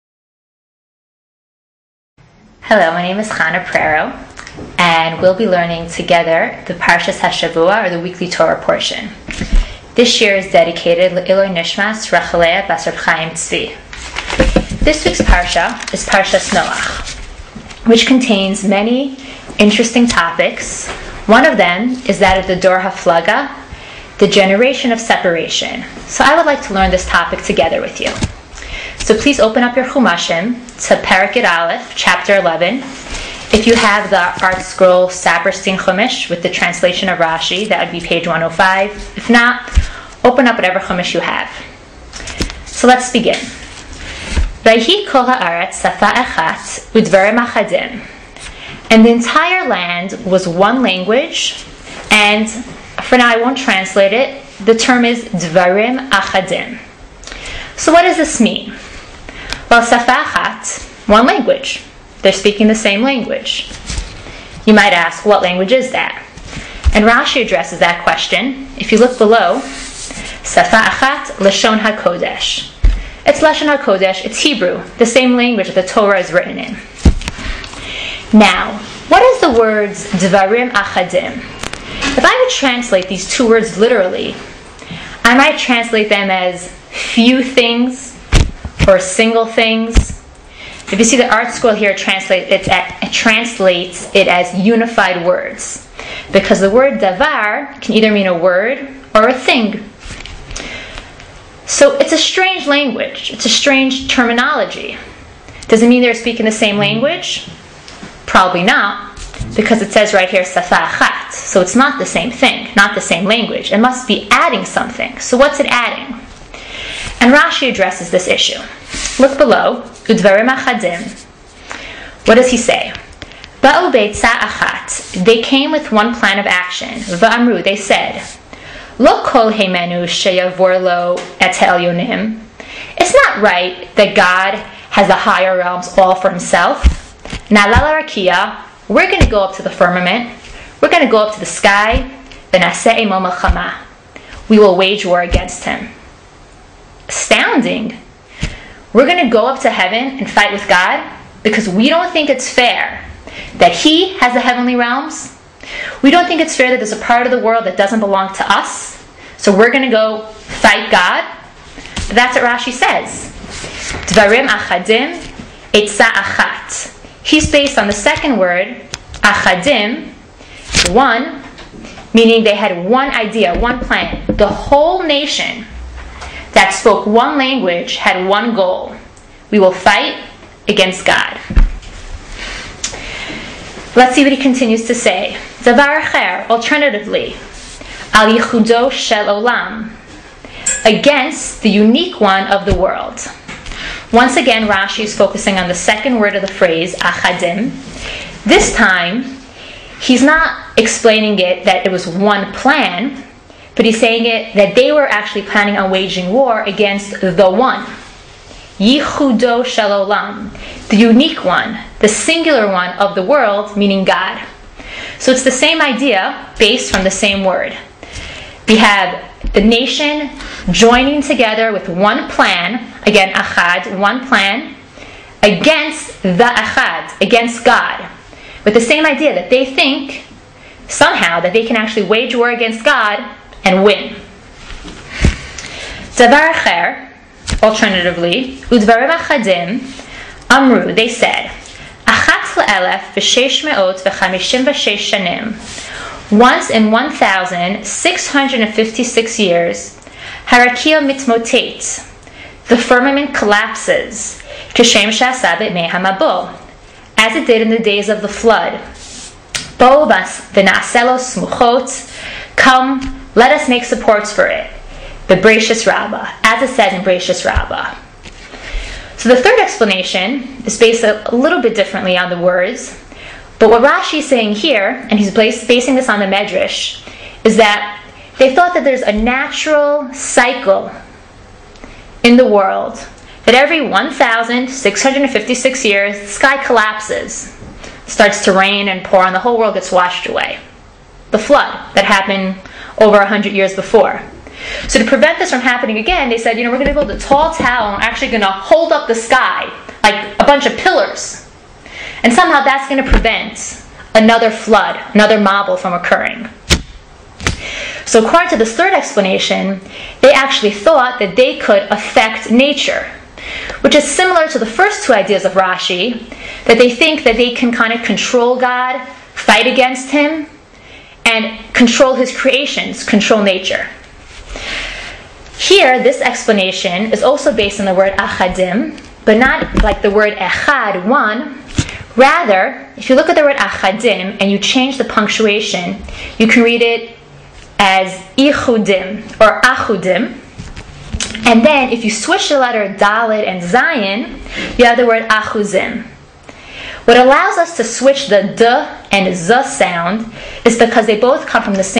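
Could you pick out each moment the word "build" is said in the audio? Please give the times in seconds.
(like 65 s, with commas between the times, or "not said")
296 s.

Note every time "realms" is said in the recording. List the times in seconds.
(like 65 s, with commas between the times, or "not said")
135 s, 154 s.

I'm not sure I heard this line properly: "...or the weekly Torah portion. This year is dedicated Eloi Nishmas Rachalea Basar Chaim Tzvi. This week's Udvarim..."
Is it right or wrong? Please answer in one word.
wrong.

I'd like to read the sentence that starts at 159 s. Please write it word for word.
So we're going to go fight God.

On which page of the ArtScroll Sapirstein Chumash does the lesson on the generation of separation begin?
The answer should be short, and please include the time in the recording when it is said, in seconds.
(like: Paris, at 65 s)
105, at 38 s.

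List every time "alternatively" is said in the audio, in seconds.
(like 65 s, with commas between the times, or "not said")
185 s, 237 s.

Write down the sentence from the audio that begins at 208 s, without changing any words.
Yichudo Shalolam, the unique one, the singular one of the world, meaning God.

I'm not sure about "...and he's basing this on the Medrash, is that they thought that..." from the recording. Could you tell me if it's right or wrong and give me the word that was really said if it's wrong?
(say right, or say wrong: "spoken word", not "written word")
right.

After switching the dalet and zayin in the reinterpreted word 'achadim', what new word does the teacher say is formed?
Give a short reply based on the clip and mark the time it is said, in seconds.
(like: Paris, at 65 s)
achuzim, at 345 s.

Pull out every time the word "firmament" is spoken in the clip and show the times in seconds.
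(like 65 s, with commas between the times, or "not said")
139 s, 252 s.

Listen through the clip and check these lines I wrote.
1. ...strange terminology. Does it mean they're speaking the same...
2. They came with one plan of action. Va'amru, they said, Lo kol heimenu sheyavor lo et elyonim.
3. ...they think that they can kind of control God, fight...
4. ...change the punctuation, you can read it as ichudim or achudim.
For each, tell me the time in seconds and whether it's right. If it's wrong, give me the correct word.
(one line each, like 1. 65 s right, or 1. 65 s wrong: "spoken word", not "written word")
1. 103 s right
2. 125 s right
3. 316 s right
4. 334 s right.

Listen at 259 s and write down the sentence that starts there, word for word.
Boobas v'na'aselo smuchot, come let us make supports for it.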